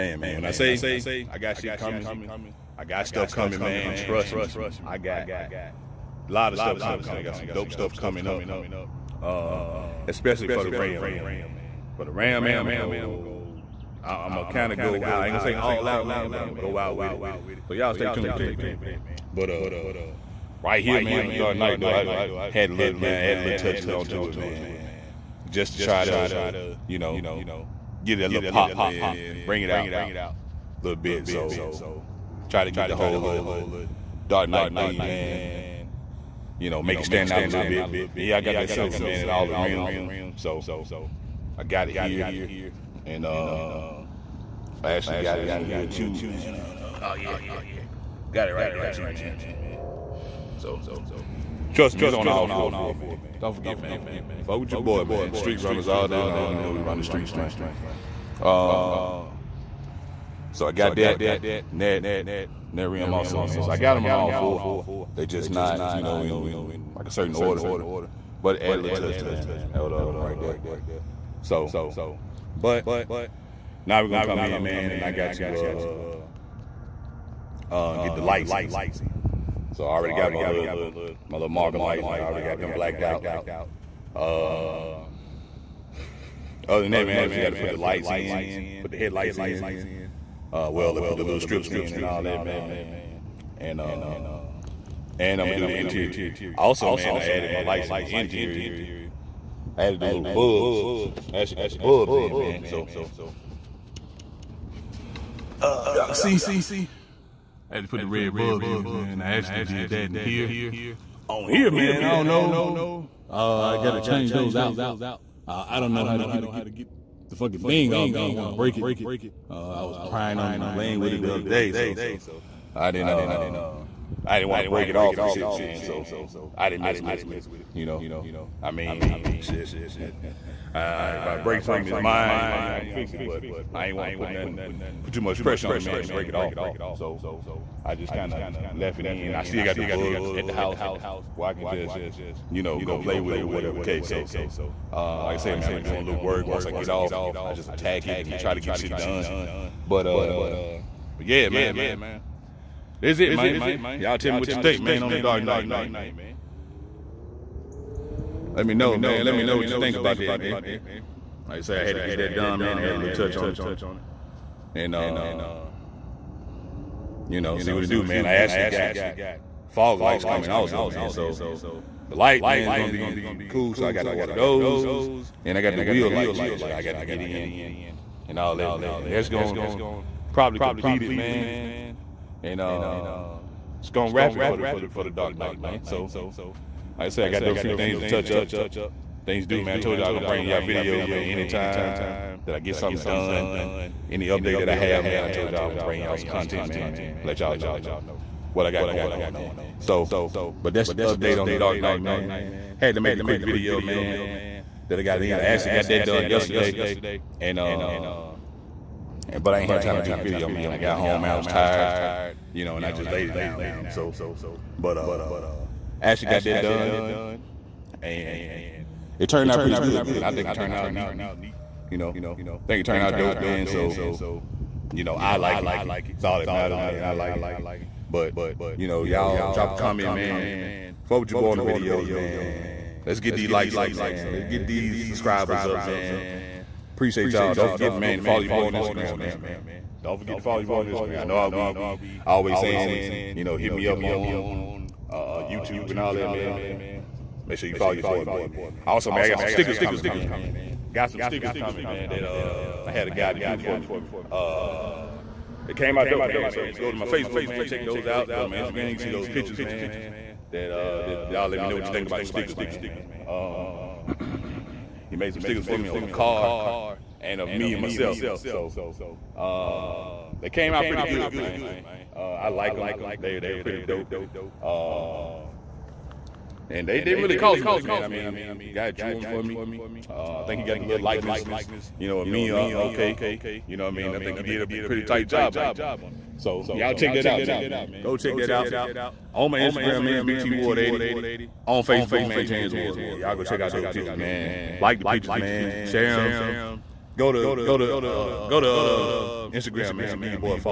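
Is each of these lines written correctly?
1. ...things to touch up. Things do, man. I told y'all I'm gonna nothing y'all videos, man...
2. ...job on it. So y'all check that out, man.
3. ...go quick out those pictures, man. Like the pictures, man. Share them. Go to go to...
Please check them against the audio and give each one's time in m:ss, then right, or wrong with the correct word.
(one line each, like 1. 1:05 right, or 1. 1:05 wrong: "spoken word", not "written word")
1. 3:07 wrong: "bring", not "nothing"
2. 4:45 right
3. 4:53 wrong: "check", not "quick".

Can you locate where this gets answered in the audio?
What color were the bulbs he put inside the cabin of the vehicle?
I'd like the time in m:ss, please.
1:48.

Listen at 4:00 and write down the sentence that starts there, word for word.
Don't forget to follow your boy on Instagram.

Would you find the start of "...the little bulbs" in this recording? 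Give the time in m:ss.
1:40.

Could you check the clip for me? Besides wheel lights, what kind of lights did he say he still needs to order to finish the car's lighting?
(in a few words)
Fog lights.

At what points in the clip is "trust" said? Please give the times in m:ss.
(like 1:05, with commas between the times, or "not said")
0:03, 0:51.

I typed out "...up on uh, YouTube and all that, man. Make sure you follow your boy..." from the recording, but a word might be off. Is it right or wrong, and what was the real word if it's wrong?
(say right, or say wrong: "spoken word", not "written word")
right.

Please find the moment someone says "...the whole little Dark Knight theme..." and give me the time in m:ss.
0:32.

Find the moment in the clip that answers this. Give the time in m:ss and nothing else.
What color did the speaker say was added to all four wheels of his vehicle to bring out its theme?
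0:38.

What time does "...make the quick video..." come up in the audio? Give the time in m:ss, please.
3:23.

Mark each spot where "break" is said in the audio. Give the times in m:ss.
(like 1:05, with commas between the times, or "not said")
1:58, 2:04, 2:11, 2:16.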